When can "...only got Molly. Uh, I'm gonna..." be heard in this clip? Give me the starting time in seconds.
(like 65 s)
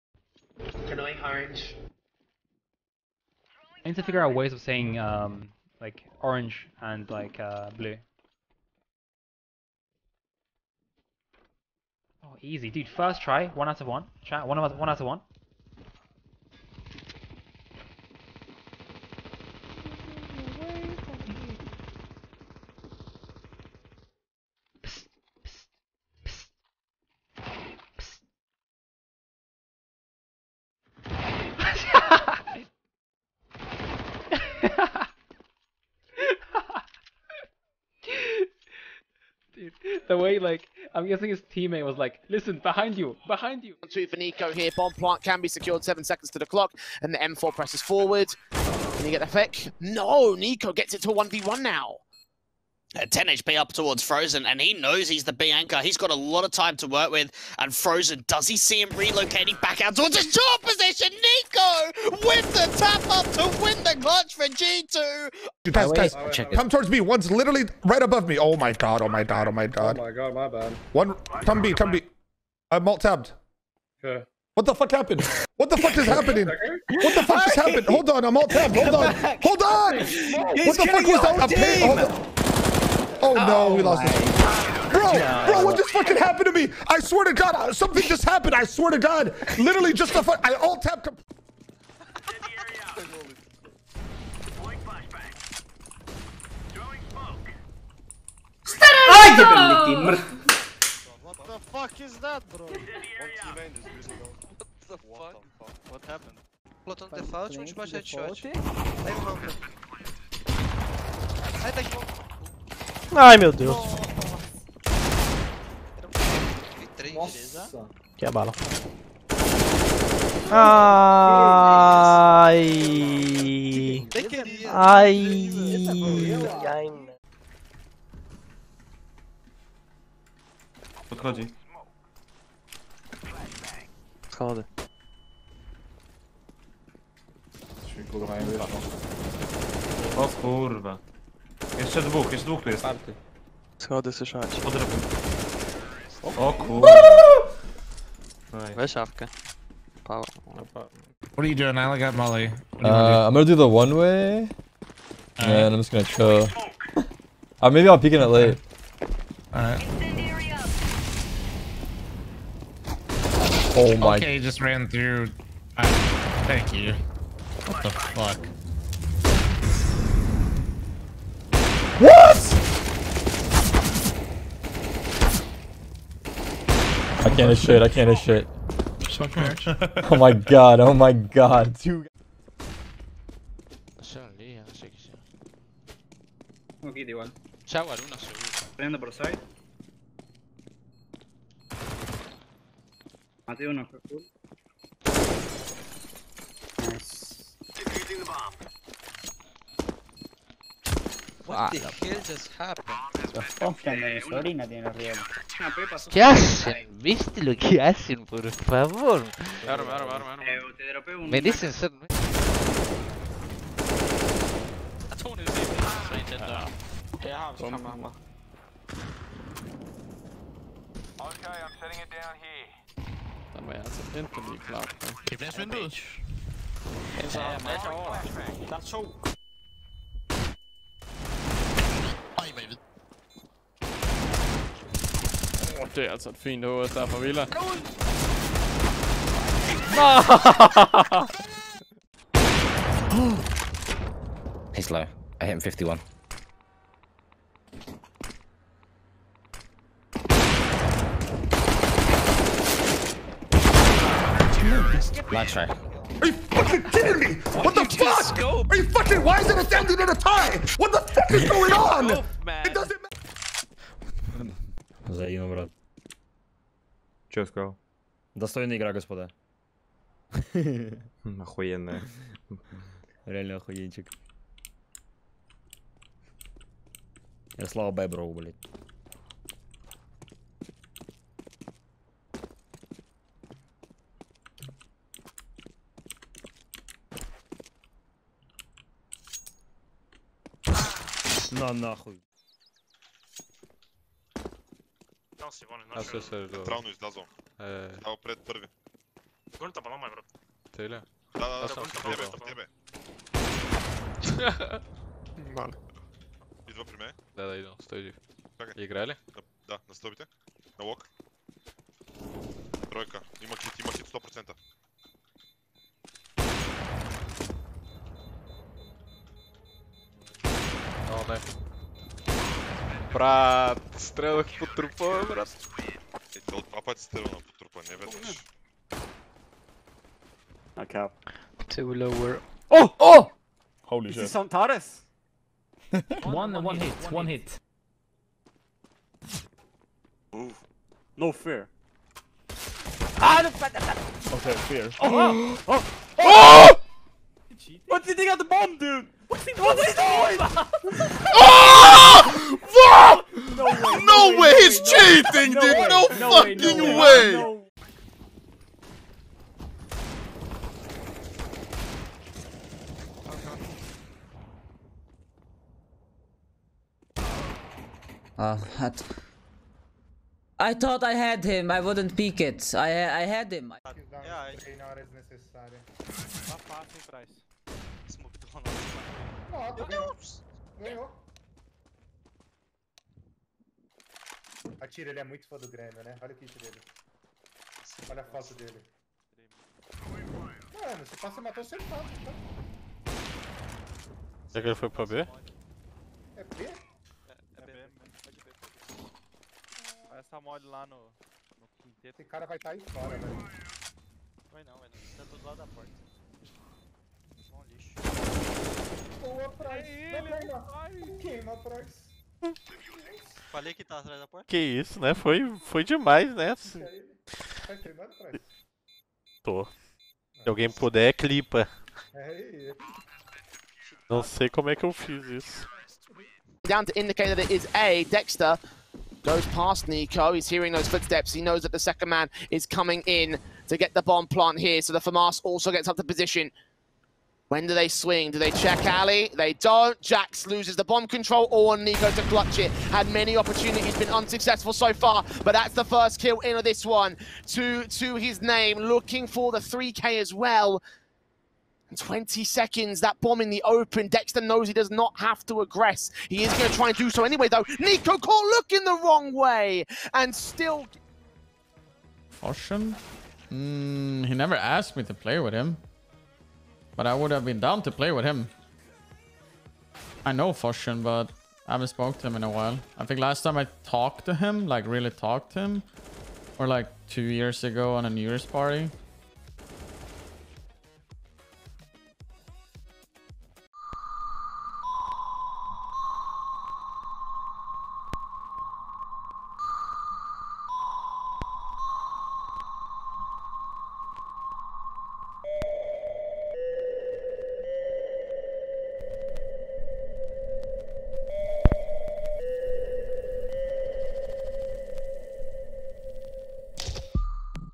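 151 s.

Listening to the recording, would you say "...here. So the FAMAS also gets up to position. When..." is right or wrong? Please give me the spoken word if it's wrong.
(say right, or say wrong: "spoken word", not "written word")
right.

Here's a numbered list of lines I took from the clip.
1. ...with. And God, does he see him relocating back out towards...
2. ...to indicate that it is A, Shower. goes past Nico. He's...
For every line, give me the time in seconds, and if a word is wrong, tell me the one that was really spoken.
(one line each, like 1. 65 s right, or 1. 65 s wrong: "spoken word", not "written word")
1. 57 s wrong: "Frozen", not "God"
2. 426 s wrong: "Dexter", not "Shower".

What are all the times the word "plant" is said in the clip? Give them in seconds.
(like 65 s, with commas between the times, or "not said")
44 s, 434 s.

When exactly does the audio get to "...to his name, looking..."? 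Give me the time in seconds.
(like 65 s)
447 s.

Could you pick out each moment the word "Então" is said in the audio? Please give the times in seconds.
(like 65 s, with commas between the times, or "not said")
392 s.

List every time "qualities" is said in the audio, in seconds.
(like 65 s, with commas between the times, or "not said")
not said.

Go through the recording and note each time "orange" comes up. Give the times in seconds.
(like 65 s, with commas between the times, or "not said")
1 s, 6 s.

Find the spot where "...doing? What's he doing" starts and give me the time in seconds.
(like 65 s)
349 s.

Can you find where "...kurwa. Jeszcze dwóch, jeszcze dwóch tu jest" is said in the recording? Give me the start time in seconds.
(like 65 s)
140 s.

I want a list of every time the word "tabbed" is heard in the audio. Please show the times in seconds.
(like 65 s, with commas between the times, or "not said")
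72 s, 78 s, 90 s.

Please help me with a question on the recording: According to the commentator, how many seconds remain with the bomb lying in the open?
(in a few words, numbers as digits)
20.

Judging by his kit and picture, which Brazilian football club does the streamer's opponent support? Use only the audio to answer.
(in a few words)
Grêmio.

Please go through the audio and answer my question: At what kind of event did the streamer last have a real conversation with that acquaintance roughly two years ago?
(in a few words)
New Year's party.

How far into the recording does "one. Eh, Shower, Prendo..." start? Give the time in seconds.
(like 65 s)
186 s.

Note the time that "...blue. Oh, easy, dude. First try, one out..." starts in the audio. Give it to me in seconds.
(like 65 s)
7 s.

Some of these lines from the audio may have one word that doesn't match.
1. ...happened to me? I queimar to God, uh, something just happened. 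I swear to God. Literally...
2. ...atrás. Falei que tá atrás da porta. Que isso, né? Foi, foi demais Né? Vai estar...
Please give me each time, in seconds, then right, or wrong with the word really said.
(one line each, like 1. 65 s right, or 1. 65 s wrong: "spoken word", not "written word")
1. 86 s wrong: "swear", not "queimar"
2. 411 s wrong: "queimar", not "estar".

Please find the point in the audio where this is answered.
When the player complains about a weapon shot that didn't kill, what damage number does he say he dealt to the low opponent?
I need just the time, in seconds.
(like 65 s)
245 s.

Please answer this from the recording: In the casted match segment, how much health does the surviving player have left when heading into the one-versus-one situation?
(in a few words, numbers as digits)
10 HP.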